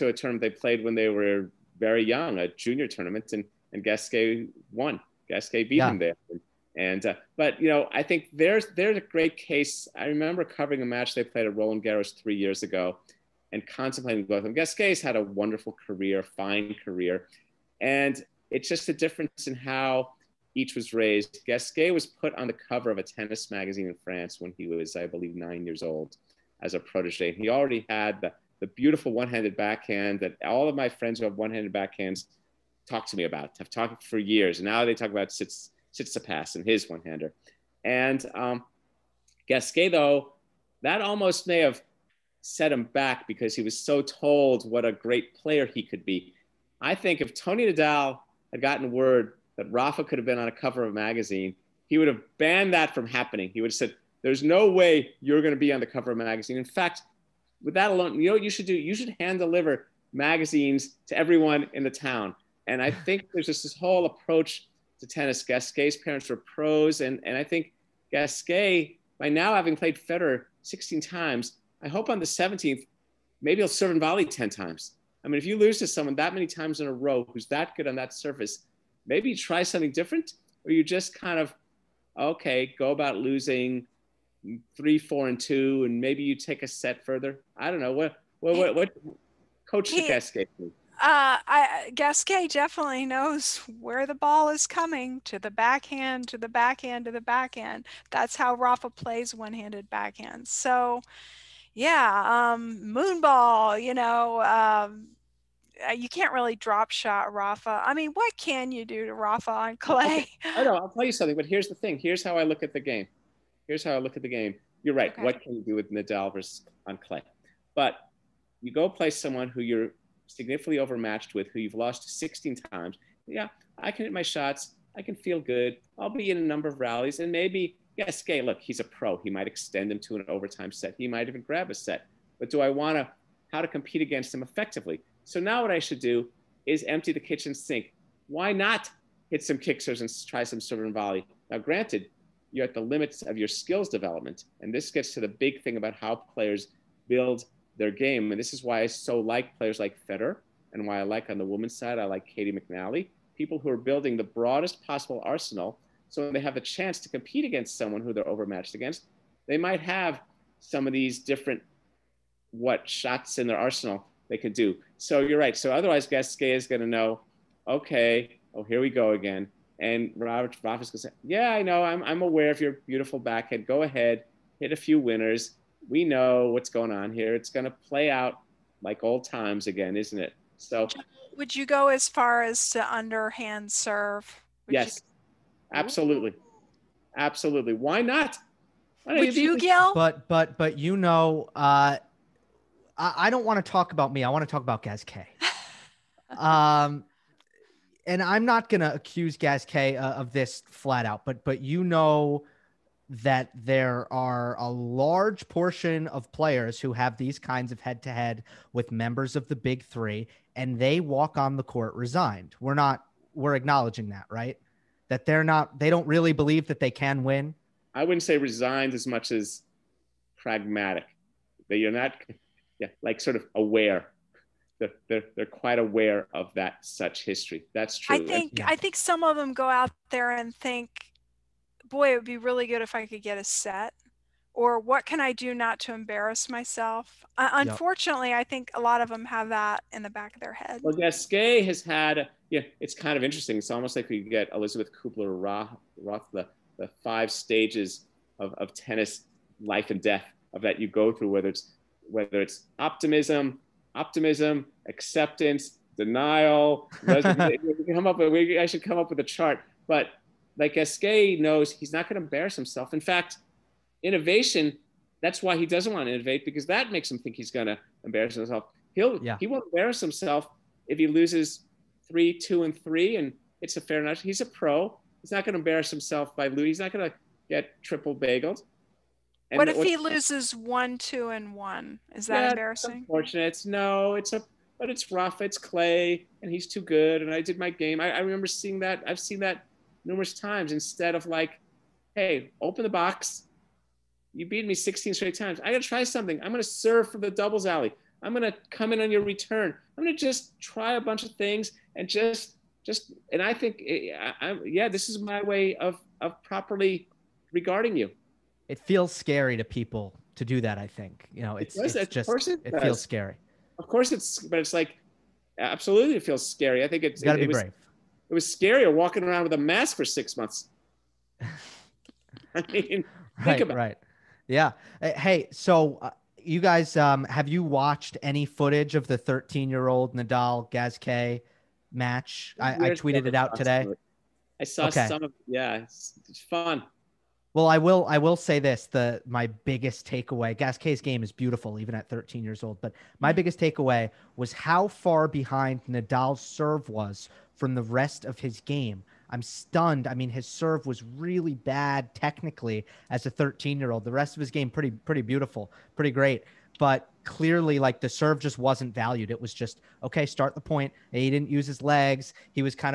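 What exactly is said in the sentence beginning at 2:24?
And this gets to the big thing about how players build their game.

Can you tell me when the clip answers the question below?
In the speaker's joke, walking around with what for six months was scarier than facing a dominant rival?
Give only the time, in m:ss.
5:19.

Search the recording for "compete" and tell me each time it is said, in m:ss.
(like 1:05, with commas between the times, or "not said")
2:13, 2:37.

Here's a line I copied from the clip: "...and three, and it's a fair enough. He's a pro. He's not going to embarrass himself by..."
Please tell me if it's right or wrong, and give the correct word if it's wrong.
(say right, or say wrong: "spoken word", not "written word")
right.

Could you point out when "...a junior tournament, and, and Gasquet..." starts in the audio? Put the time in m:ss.
0:02.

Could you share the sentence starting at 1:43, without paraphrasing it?
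You know, um, uh, you can't really drop shot Rafa.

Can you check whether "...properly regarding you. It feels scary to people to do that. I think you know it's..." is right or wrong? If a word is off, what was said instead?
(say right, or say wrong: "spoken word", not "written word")
right.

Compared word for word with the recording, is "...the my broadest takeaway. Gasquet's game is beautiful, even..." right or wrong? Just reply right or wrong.
wrong.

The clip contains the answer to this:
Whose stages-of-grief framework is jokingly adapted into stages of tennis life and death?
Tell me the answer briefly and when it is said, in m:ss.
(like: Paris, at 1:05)
Elizabeth Kubler-Ross, at 4:04.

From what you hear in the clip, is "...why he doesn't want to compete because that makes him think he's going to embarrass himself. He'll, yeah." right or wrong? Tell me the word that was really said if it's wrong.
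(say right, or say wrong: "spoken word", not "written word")
wrong: "innovate", not "compete".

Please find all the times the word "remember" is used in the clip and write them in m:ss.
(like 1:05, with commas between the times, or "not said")
0:10, 4:48.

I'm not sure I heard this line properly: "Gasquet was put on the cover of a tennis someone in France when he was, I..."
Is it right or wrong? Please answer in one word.
wrong.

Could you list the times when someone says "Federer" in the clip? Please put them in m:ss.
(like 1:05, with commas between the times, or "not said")
1:09, 2:30.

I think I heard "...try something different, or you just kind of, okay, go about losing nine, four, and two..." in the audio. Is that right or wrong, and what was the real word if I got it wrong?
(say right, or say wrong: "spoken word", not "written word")
wrong: "three", not "nine".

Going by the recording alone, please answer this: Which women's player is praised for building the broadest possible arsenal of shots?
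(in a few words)
Caty McNally.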